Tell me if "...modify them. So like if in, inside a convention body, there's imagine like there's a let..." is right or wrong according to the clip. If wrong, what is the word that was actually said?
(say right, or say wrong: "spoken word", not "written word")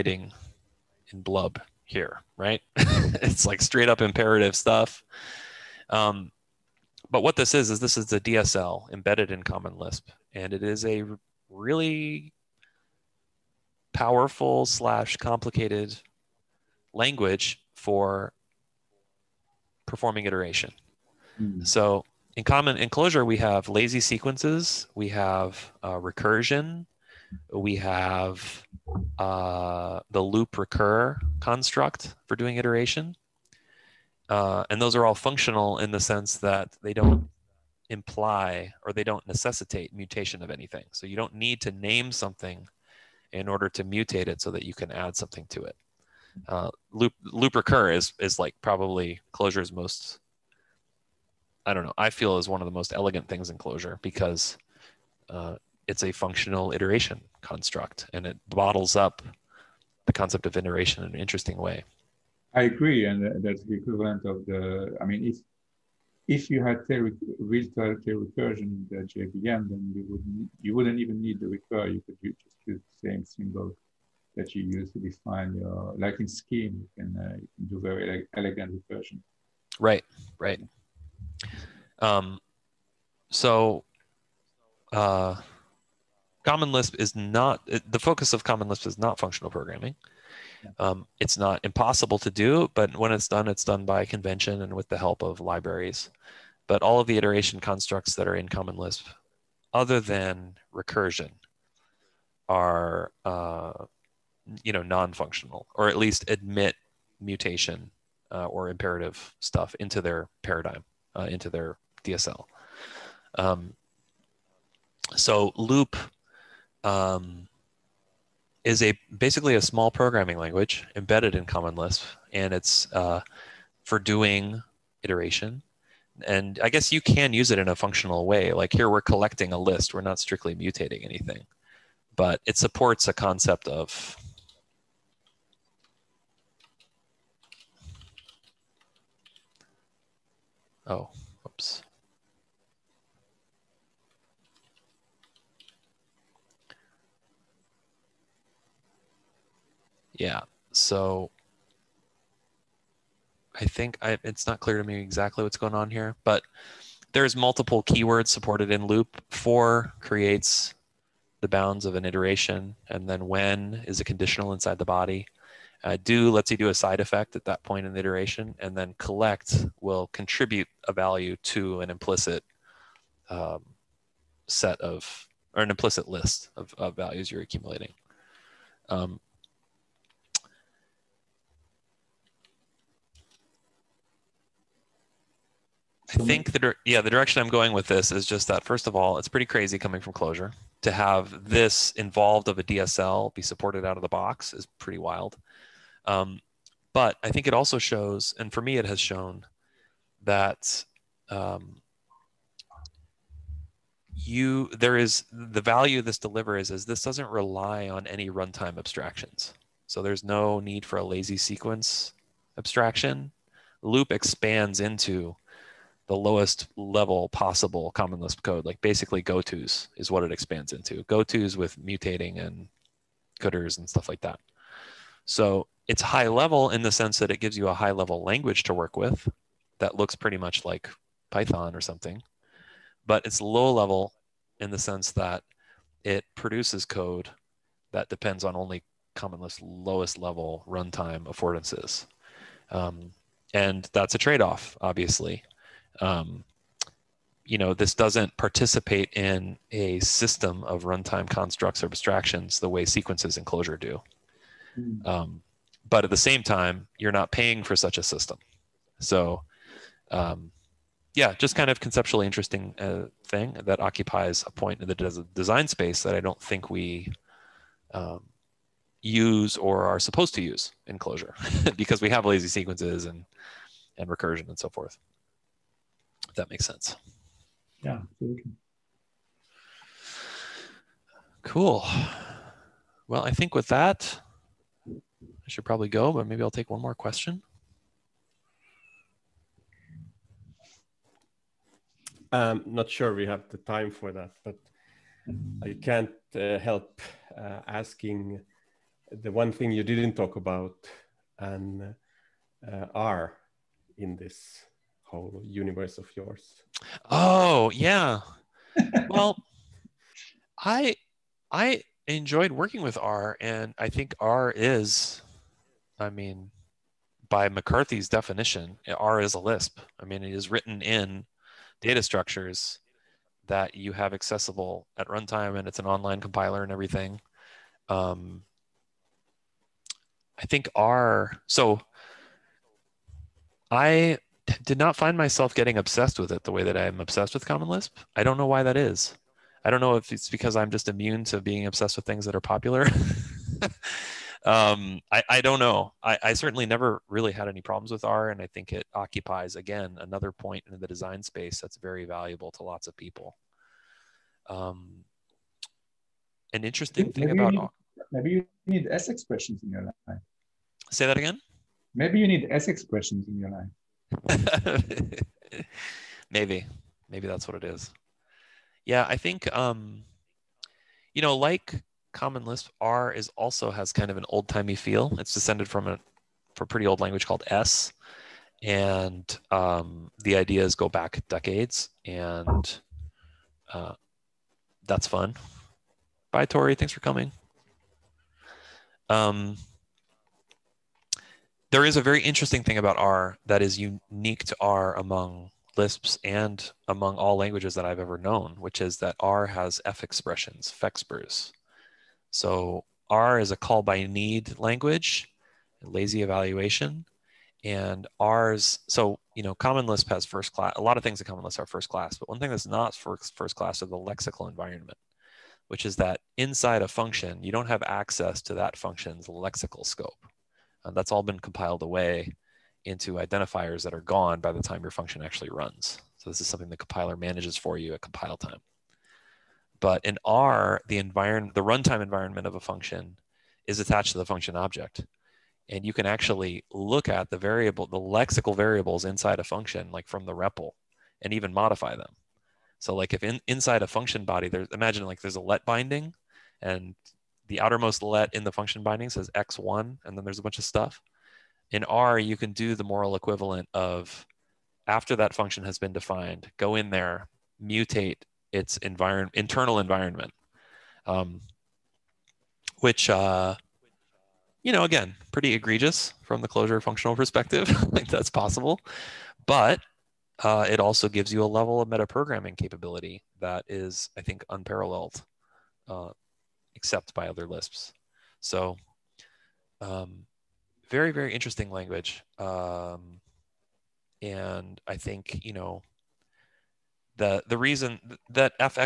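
wrong: "function", not "convention".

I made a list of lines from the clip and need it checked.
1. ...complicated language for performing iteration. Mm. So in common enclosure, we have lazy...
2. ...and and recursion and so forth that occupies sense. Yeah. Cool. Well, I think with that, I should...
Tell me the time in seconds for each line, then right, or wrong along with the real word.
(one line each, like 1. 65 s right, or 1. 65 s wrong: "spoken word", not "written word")
1. 15 s right
2. 273 s wrong: "makes", not "occupies".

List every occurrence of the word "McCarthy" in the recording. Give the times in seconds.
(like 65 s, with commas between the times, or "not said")
317 s.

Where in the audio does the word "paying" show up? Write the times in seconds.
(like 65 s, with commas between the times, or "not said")
257 s.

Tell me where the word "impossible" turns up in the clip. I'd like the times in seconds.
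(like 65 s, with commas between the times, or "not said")
91 s.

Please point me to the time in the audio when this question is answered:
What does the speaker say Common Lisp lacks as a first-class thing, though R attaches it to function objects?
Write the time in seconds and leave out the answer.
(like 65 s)
413 s.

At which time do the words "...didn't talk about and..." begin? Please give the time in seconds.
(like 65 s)
299 s.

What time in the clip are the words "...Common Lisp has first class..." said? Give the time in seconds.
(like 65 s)
409 s.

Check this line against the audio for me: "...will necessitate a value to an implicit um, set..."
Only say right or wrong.
wrong.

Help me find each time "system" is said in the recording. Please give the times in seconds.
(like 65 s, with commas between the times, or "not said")
250 s, 258 s.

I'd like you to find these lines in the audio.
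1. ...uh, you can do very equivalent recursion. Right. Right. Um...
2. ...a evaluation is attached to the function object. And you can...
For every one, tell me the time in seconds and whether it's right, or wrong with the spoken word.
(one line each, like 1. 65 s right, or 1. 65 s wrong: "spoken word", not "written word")
1. 77 s wrong: "elegant", not "equivalent"
2. 432 s wrong: "function", not "evaluation".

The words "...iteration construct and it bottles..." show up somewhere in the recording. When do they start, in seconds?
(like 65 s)
56 s.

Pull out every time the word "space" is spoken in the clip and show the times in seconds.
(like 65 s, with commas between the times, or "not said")
265 s, 351 s.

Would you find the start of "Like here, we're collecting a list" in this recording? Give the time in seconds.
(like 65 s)
128 s.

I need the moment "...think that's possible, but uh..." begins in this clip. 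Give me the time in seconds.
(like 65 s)
467 s.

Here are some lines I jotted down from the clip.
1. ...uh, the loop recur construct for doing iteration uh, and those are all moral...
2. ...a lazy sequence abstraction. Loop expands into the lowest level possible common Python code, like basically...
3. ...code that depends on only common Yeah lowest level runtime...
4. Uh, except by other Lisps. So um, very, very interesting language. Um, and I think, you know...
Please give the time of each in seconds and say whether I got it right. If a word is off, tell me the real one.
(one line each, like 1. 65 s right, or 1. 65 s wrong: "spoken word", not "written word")
1. 29 s wrong: "functional", not "moral"
2. 210 s wrong: "Lisp", not "Python"
3. 236 s wrong: "Lisp", not "Yeah"
4. 475 s right.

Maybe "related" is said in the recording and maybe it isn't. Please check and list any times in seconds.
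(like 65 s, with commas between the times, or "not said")
not said.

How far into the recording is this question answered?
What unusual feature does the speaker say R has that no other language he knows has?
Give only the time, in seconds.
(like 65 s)
399 s.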